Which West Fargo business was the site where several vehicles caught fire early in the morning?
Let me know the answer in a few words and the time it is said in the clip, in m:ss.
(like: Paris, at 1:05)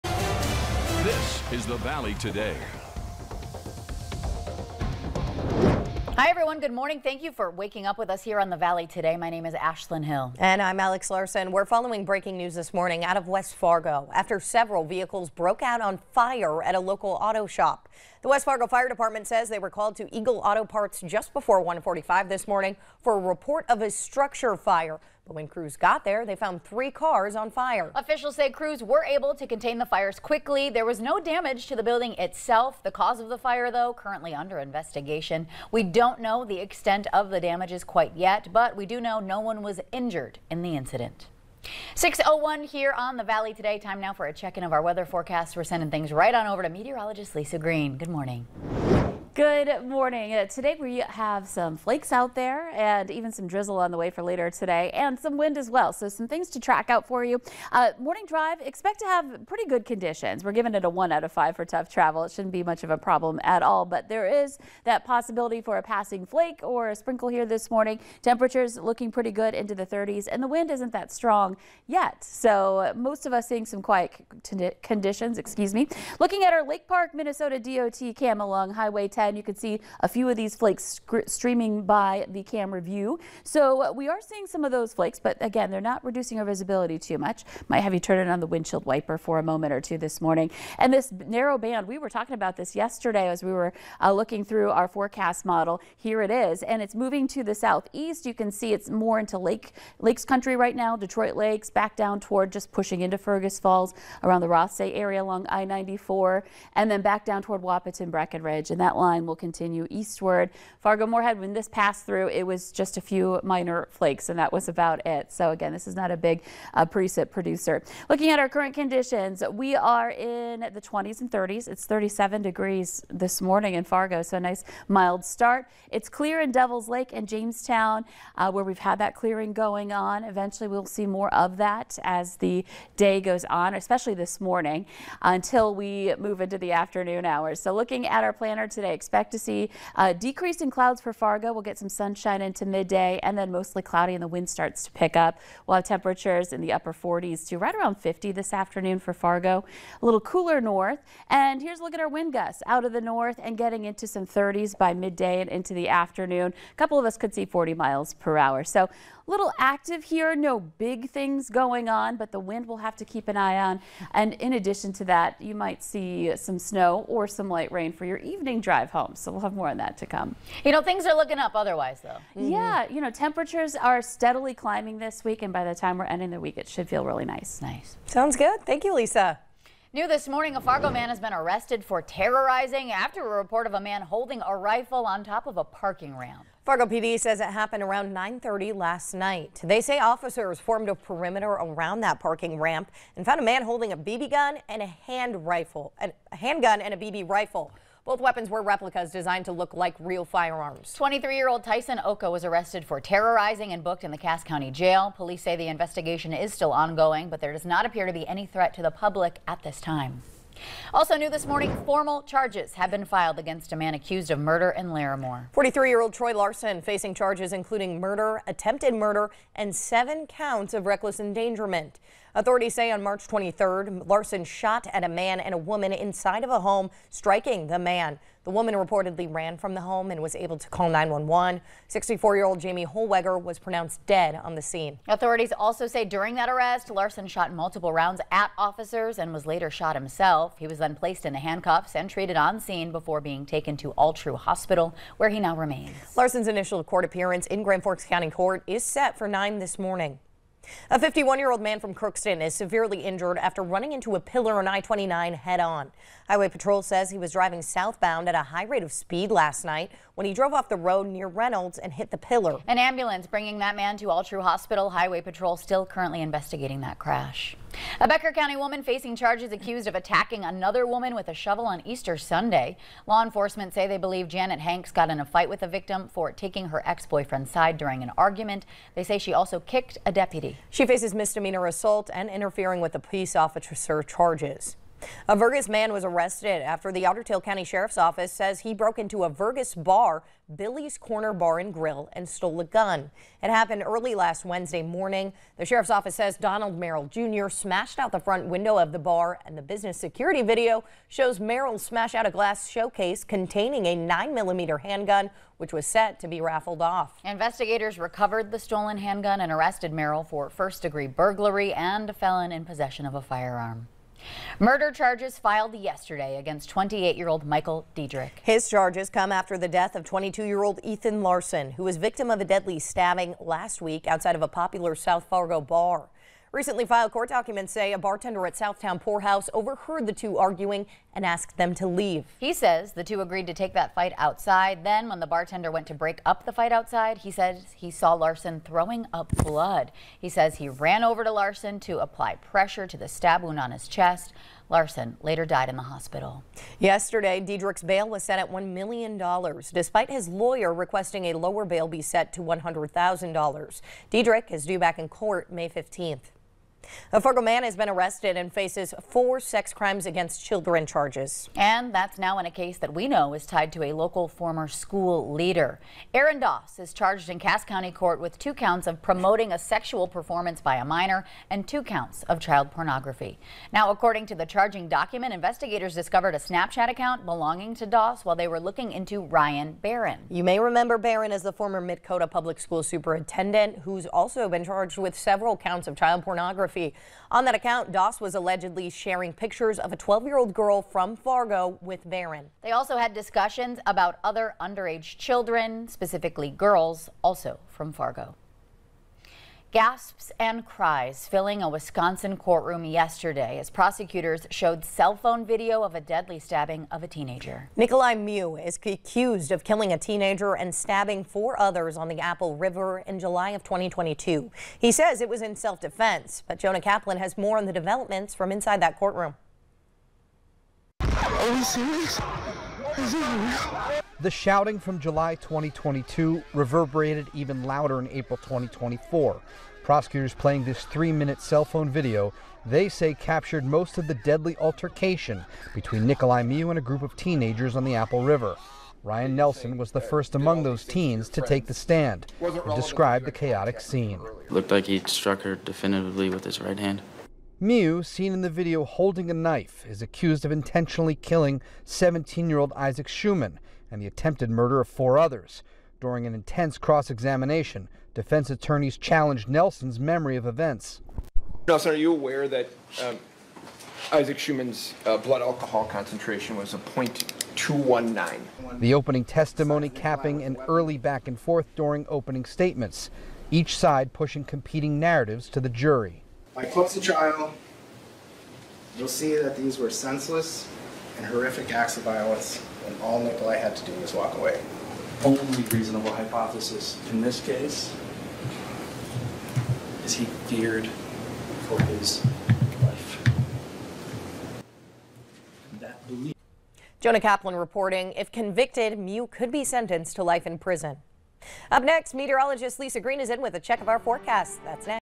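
Eagle Auto Parts, at 0:20.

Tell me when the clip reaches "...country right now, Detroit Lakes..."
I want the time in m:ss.
1:40.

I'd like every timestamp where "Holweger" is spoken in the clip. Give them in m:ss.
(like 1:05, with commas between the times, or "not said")
3:52.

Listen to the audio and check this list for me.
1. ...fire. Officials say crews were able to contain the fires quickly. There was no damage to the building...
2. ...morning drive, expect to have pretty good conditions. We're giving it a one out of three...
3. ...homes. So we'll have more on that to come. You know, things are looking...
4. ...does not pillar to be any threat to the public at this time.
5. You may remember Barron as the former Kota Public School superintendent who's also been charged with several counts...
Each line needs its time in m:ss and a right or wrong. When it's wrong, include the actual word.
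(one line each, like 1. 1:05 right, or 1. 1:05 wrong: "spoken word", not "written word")
1. 0:27 right
2. 0:57 wrong: "five", not "three"
3. 2:48 right
4. 3:27 wrong: "appear", not "pillar"
5. 6:20 right.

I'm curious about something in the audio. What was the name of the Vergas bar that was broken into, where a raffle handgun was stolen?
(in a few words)
Billy's Corner Bar and Grill.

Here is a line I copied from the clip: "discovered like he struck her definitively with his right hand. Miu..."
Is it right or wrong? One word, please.
wrong.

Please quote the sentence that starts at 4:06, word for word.
Larson's initial court appearance in Grand Forks County Court is set for 9 this morning.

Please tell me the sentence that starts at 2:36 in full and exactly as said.
A couple of us could see 40 miles per hour.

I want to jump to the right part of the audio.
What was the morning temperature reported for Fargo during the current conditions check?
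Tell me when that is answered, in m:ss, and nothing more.
2:01.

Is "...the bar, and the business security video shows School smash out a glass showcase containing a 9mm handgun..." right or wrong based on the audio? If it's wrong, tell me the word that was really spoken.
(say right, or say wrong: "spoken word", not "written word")
wrong: "Merrill", not "School".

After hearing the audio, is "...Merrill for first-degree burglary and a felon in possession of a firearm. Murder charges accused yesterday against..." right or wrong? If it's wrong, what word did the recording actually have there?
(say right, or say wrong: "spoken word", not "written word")
wrong: "filed", not "accused".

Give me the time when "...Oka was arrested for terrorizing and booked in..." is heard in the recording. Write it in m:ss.
3:22.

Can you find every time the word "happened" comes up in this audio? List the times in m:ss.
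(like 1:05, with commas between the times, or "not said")
3:07, 4:53.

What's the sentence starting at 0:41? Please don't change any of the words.
601 here on the Valley today.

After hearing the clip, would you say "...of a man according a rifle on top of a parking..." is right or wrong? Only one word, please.
wrong.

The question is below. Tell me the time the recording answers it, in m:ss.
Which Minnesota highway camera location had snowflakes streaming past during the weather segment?
1:16.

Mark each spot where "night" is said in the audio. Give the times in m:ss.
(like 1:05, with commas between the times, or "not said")
3:09, 4:19.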